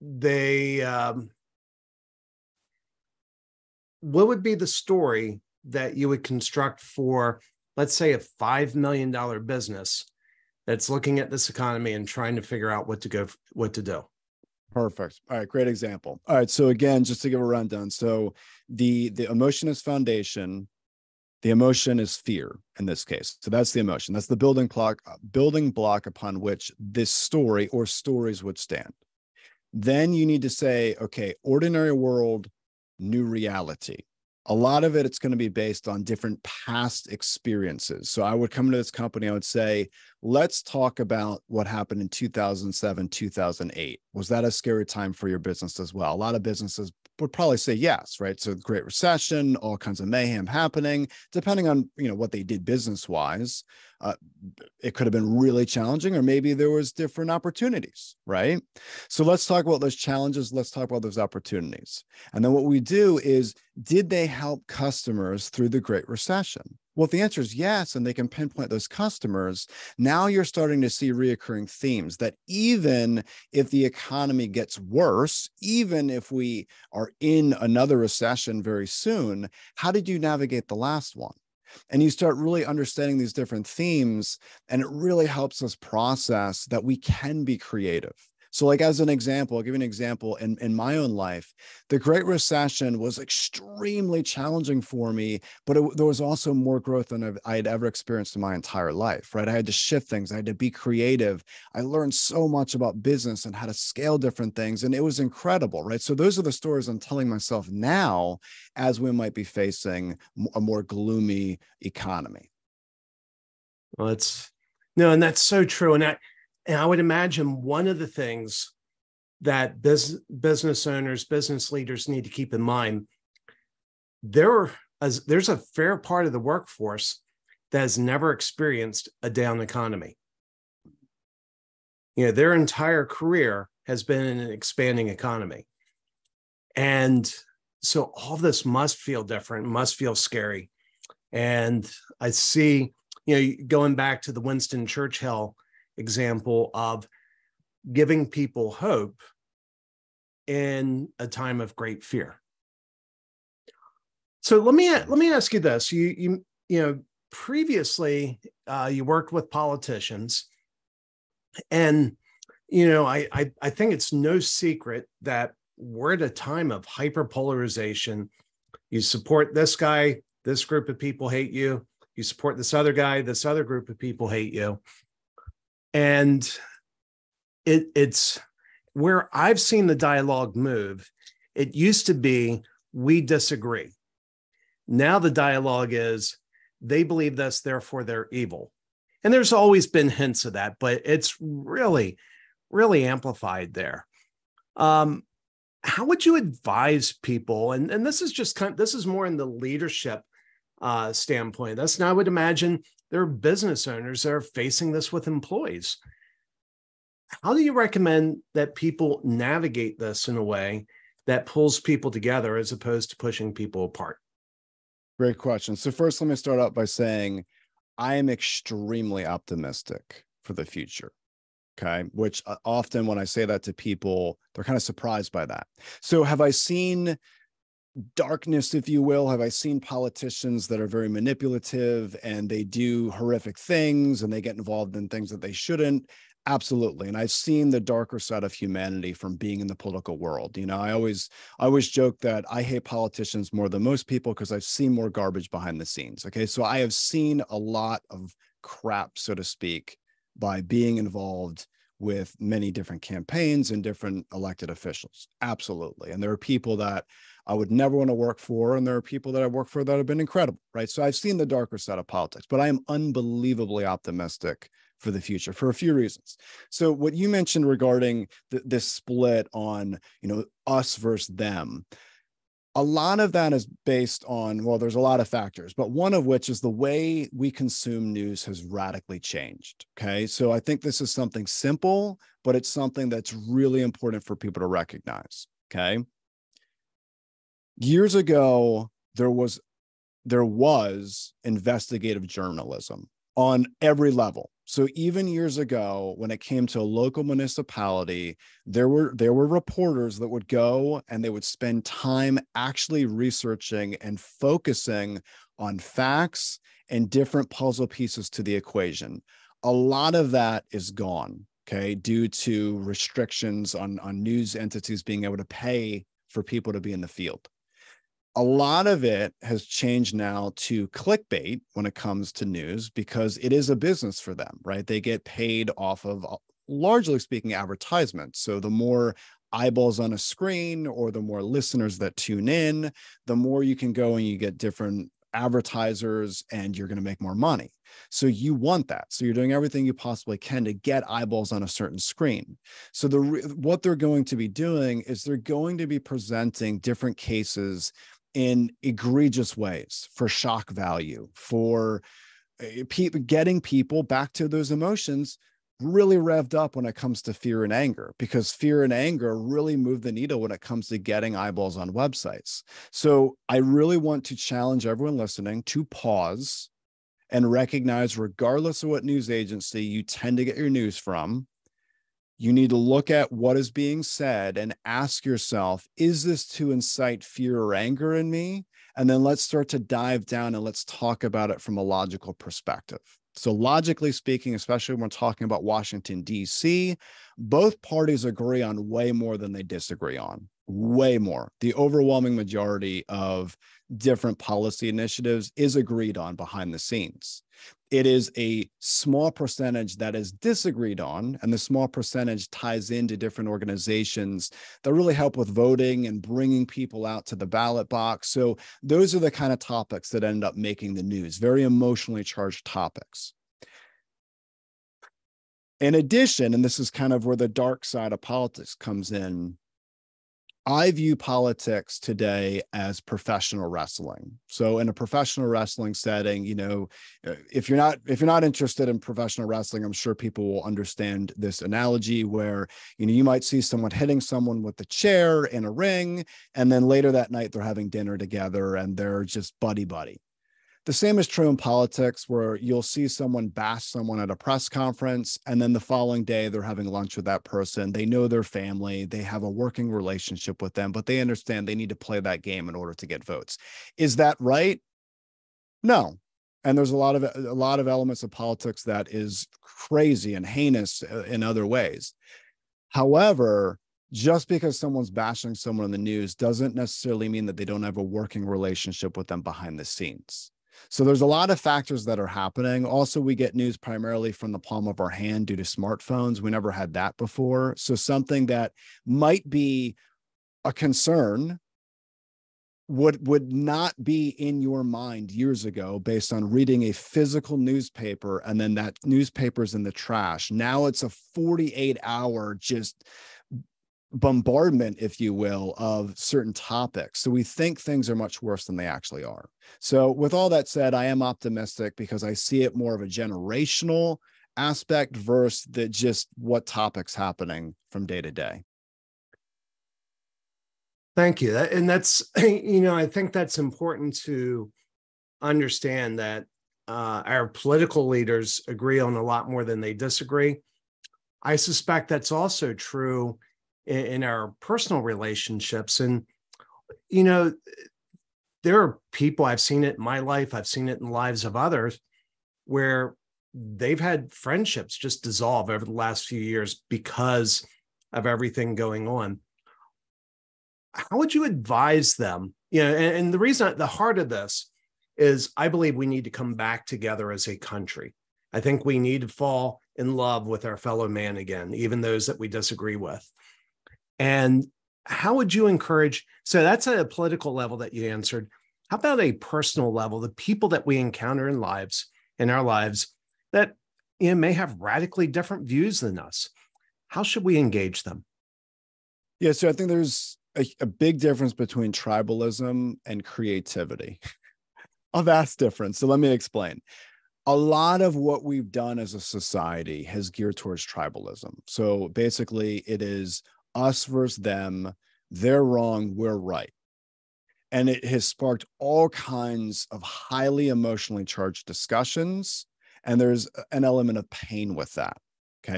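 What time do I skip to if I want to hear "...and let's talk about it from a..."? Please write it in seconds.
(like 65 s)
380 s.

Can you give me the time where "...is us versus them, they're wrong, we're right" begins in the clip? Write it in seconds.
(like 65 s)
583 s.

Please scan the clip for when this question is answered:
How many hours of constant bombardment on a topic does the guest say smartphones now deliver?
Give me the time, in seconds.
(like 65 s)
491 s.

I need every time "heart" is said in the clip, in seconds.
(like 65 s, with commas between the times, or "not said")
543 s.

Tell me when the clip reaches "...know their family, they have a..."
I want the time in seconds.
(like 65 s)
448 s.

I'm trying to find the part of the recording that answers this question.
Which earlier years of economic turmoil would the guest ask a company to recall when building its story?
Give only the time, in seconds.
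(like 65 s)
42 s.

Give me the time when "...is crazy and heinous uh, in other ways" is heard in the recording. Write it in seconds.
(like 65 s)
459 s.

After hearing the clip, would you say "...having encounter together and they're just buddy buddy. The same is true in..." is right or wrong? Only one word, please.
wrong.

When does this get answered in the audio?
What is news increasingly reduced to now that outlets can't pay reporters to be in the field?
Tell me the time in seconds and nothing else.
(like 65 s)
320 s.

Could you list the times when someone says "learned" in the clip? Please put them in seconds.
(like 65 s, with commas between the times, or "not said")
101 s.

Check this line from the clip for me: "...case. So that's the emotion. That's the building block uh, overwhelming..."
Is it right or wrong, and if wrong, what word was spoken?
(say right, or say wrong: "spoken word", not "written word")
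wrong: "building", not "overwhelming".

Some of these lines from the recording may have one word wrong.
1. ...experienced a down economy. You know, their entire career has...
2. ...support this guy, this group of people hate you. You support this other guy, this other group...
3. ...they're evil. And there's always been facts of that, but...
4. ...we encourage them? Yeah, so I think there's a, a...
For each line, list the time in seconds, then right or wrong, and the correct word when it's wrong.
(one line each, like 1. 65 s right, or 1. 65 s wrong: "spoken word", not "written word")
1. 128 s right
2. 169 s right
3. 188 s wrong: "hints", not "facts"
4. 567 s wrong: "engage", not "encourage".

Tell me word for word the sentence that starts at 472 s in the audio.
Also, we get news primarily from the palm of our hand due to smartphones.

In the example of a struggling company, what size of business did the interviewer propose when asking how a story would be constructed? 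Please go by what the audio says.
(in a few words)
$5 million.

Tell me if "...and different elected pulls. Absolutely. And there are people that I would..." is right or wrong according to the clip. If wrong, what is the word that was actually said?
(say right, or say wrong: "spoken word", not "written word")
wrong: "officials", not "pulls".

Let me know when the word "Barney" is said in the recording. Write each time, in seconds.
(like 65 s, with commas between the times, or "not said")
not said.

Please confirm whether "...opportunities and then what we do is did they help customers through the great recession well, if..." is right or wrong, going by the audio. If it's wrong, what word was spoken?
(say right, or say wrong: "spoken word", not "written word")
right.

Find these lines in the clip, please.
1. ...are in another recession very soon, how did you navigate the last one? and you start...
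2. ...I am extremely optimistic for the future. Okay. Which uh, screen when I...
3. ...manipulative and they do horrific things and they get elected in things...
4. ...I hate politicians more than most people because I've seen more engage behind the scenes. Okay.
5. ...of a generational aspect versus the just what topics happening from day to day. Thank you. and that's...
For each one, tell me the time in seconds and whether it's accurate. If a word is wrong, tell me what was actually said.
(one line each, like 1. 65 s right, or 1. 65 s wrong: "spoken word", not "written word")
1. 76 s right
2. 217 s wrong: "often", not "screen"
3. 231 s wrong: "involved", not "elected"
4. 242 s wrong: "garbage", not "engage"
5. 502 s right.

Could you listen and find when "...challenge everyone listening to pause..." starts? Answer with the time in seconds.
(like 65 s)
364 s.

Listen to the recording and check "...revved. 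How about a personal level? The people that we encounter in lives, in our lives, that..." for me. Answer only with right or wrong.
wrong.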